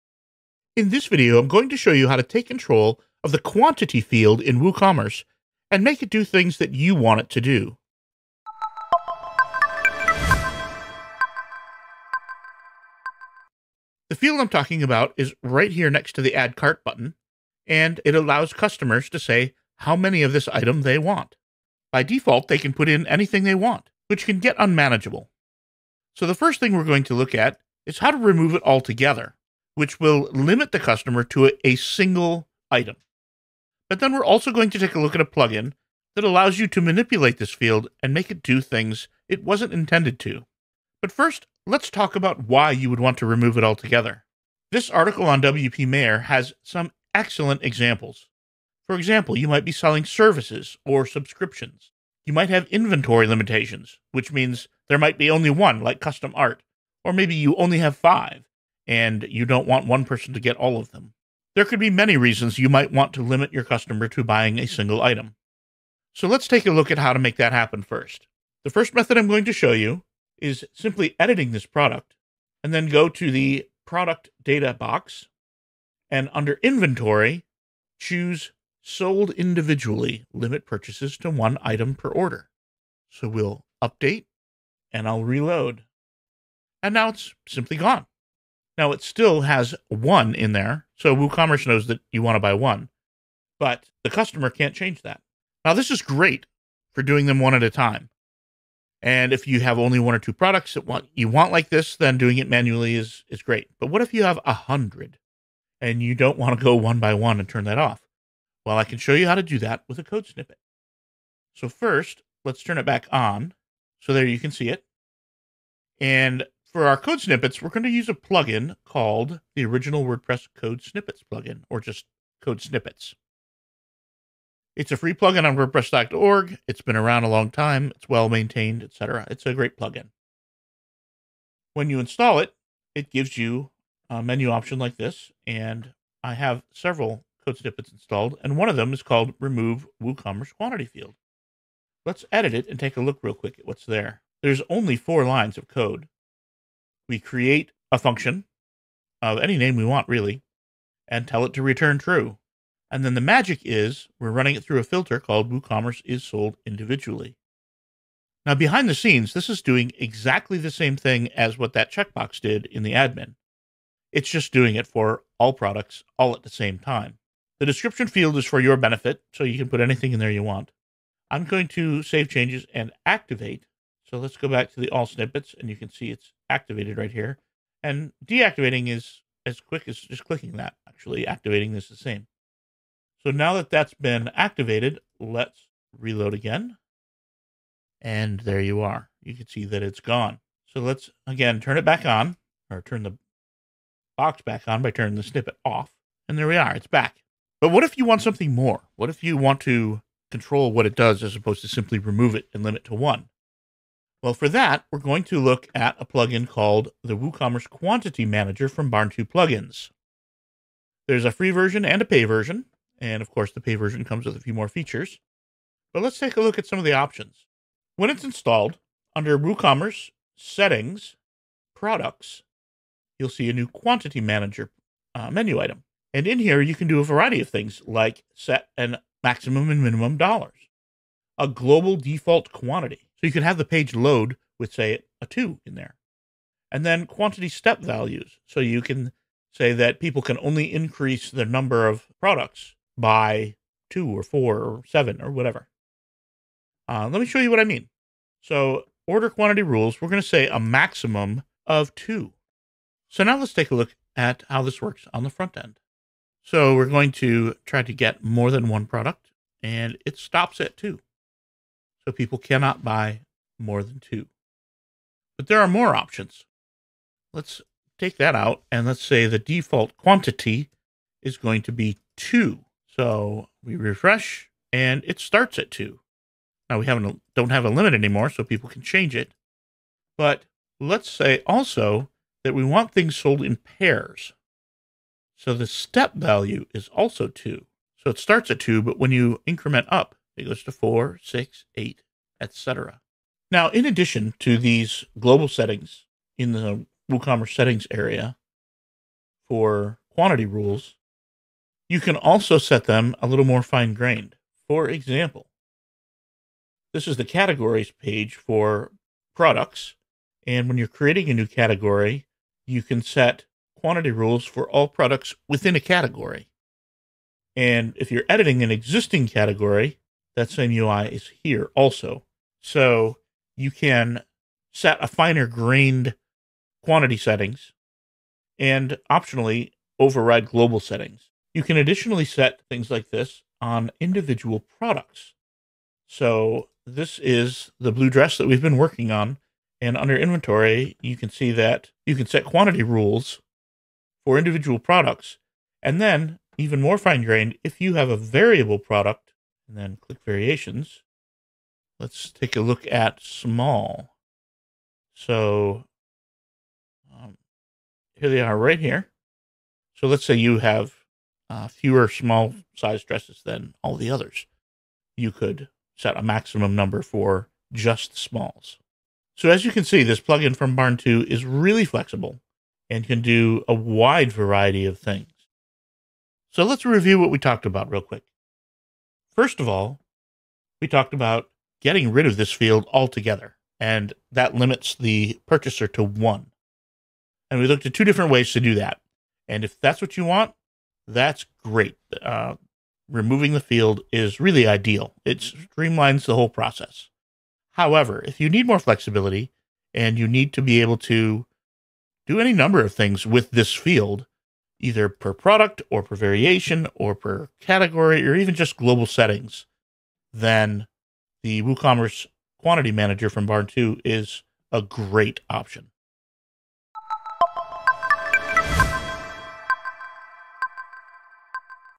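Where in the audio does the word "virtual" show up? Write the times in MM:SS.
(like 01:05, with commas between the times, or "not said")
not said.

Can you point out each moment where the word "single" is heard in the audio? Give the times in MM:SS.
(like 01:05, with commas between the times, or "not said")
00:31, 01:04.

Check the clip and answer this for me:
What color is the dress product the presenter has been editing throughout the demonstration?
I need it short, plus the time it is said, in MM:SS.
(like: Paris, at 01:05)
blue, at 05:37.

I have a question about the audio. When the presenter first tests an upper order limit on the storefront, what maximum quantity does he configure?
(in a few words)
2.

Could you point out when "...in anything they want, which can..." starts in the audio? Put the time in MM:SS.
00:22.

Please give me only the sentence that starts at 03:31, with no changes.
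There's a free version and a pay version, and of course the pay version comes with a few more features.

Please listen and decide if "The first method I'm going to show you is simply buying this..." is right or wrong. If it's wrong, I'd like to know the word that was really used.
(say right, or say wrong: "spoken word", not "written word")
wrong: "editing", not "buying".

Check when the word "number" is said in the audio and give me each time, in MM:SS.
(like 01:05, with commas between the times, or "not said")
04:01, 06:06, 06:42.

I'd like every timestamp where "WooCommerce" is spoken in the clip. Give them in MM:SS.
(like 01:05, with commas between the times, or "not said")
00:04, 01:31, 02:20, 02:35, 03:27, 03:39, 04:57, 06:51.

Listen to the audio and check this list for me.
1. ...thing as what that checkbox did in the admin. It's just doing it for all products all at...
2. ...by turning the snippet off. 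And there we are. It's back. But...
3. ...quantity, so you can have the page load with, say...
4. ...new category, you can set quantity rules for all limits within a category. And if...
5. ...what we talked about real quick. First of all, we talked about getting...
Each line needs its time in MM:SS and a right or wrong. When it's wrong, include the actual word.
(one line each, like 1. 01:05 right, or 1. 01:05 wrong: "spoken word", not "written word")
1. 02:40 right
2. 03:14 right
3. 03:52 right
4. 05:11 wrong: "products", not "limits"
5. 06:17 right.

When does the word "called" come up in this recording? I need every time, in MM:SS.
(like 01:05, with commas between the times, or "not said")
01:58, 02:19, 02:35, 03:26.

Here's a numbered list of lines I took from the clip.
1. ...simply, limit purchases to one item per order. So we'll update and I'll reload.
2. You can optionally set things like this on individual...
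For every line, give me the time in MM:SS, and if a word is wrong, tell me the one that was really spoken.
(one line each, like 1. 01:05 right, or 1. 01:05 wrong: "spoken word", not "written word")
1. 01:19 wrong: "individually", not "simply"
2. 05:31 wrong: "additionally", not "optionally".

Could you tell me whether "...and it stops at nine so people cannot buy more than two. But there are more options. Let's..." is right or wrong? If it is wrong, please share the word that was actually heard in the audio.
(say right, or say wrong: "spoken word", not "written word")
wrong: "two", not "nine".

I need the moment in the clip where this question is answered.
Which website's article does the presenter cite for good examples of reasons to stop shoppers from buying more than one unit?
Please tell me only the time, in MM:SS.
00:45.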